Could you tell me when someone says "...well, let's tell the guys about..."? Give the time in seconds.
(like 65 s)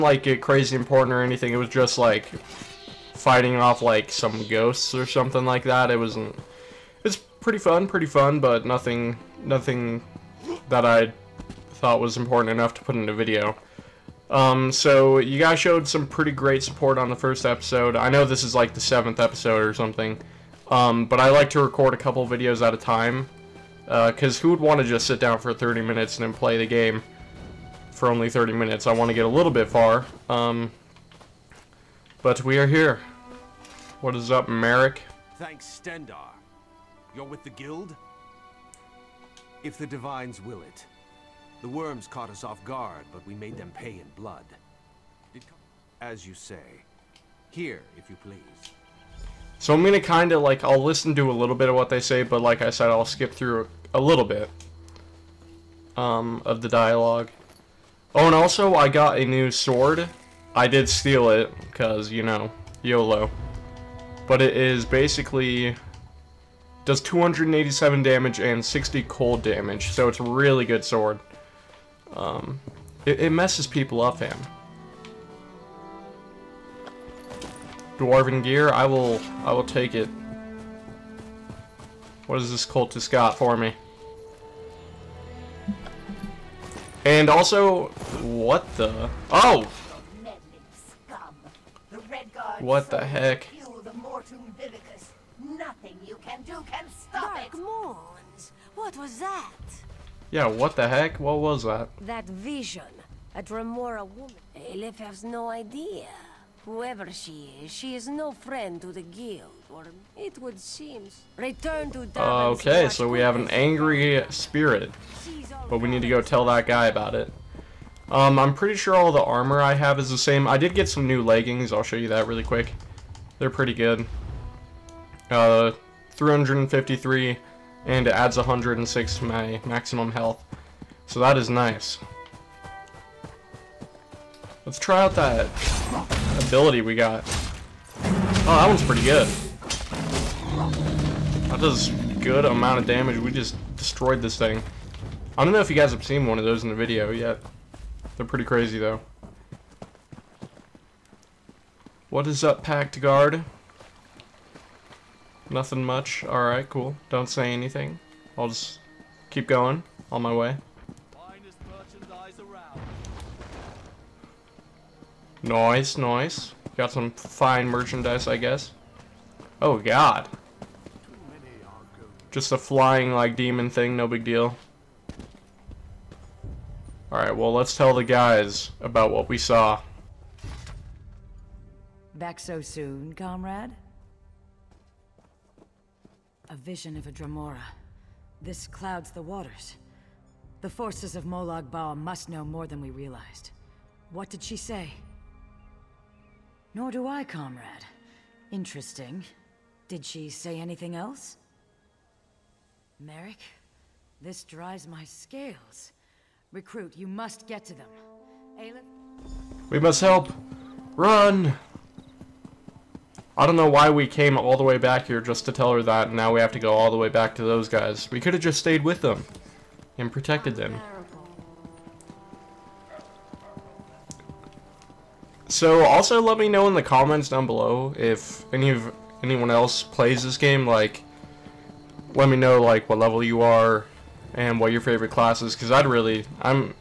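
177 s.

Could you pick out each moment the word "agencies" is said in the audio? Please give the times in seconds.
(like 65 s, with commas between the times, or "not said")
not said.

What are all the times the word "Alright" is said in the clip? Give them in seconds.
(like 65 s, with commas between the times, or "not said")
156 s, 177 s.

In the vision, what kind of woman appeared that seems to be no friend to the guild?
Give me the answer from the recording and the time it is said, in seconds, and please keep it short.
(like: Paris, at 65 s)
A Dremora woman, at 103 s.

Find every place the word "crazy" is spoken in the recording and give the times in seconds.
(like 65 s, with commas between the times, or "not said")
0 s, 148 s.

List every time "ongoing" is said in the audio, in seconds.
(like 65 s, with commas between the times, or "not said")
not said.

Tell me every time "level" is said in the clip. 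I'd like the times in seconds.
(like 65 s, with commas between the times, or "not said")
232 s.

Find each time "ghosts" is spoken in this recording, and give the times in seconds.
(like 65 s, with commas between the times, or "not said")
4 s.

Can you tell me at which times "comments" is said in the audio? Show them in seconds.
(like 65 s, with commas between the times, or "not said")
226 s.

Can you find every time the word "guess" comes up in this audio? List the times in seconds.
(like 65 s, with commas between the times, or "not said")
168 s.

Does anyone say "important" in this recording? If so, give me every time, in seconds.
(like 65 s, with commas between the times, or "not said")
0 s, 12 s.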